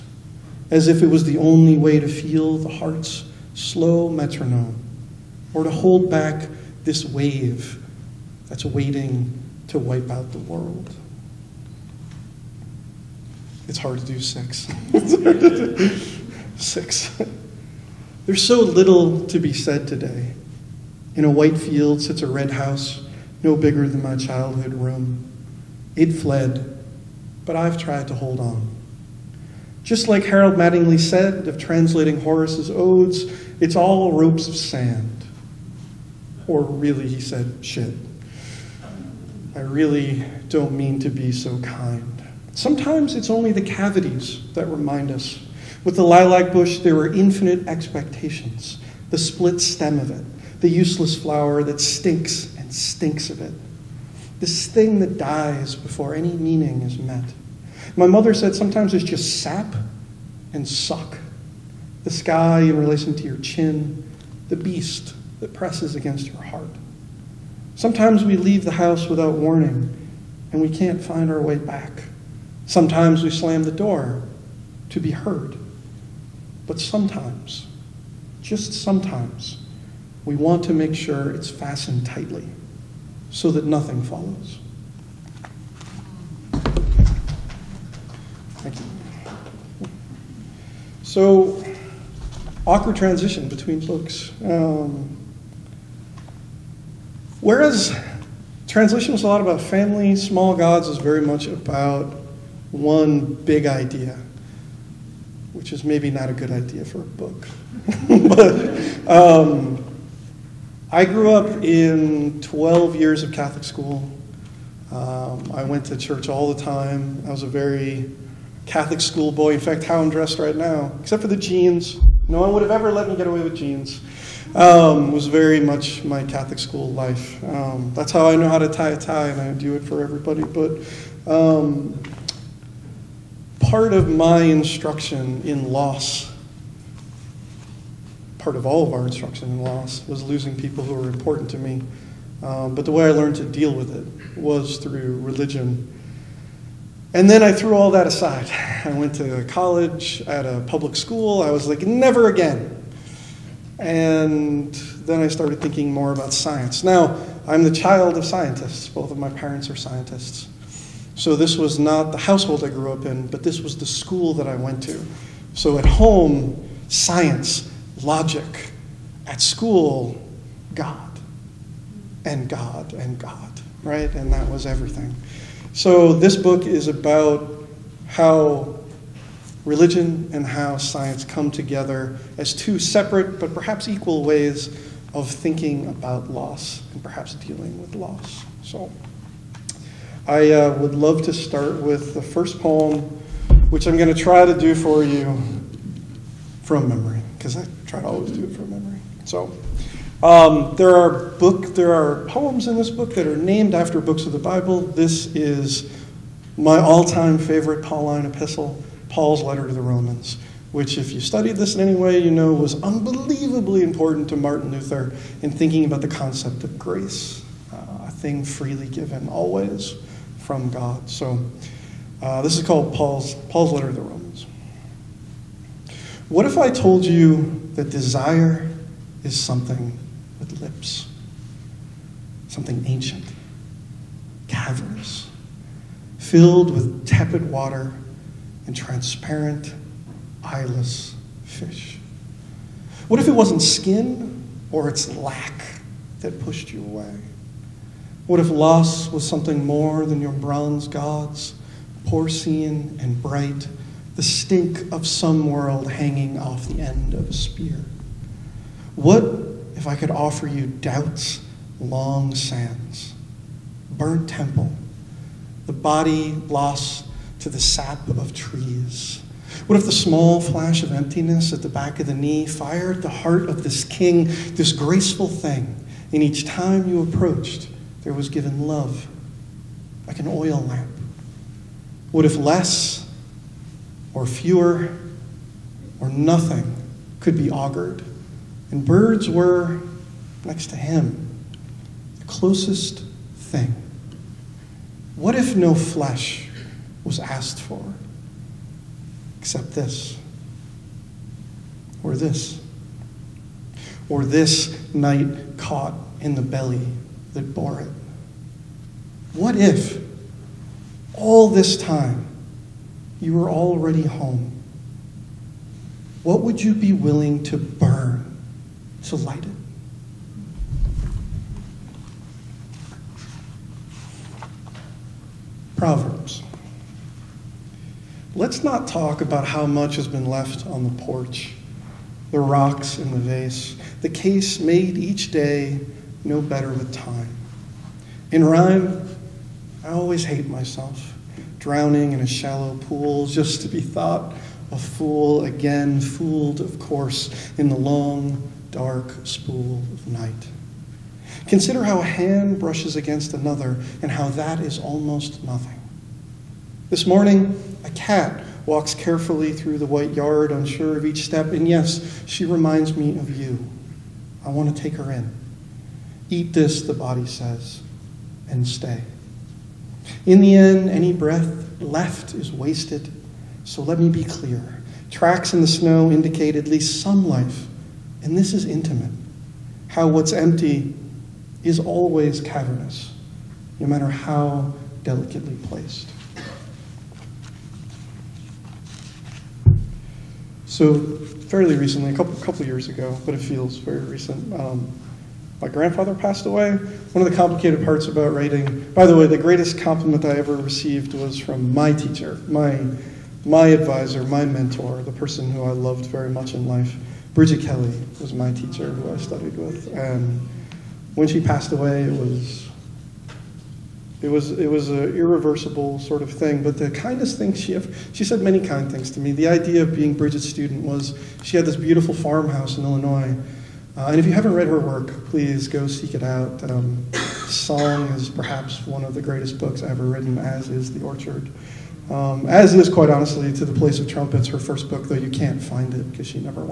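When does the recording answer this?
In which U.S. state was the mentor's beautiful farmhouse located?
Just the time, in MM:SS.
07:02.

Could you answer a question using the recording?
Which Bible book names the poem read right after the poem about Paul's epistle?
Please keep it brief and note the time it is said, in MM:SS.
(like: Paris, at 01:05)
Proverbs, at 05:25.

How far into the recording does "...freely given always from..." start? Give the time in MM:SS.
03:38.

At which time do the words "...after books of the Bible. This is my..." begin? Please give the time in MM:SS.
03:23.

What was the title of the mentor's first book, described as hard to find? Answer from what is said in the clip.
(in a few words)
To the Place of Trumpets.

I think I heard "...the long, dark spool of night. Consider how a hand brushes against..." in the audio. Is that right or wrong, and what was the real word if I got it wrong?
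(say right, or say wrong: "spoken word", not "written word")
right.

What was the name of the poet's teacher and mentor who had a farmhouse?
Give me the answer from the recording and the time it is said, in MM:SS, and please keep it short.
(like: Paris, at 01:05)
Brigit Kelly, at 06:47.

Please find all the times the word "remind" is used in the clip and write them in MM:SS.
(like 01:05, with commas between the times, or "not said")
00:44, 06:02.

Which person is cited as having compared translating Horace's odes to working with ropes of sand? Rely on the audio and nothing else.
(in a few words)
Harold Mattingly.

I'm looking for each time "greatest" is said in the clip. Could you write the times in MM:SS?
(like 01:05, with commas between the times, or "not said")
06:39, 07:09.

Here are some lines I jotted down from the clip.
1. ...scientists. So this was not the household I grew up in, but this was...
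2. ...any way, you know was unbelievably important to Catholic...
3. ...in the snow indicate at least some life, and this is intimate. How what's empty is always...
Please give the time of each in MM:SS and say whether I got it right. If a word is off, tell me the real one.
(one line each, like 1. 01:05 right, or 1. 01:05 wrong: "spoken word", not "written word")
1. 02:39 right
2. 03:31 wrong: "Martin", not "Catholic"
3. 06:15 right.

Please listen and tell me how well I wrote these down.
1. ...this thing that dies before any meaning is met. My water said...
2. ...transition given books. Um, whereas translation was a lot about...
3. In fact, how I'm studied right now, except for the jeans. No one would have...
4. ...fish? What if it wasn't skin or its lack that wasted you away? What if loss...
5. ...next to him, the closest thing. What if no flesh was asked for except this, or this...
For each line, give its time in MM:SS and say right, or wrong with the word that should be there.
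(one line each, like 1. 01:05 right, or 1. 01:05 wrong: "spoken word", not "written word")
1. 00:54 wrong: "mother", not "water"
2. 01:32 wrong: "between", not "given"
3. 01:59 wrong: "dressed", not "studied"
4. 04:01 wrong: "pushed", not "wasted"
5. 04:50 right.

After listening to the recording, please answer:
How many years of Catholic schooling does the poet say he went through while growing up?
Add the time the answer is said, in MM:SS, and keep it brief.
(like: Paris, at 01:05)
12, at 01:52.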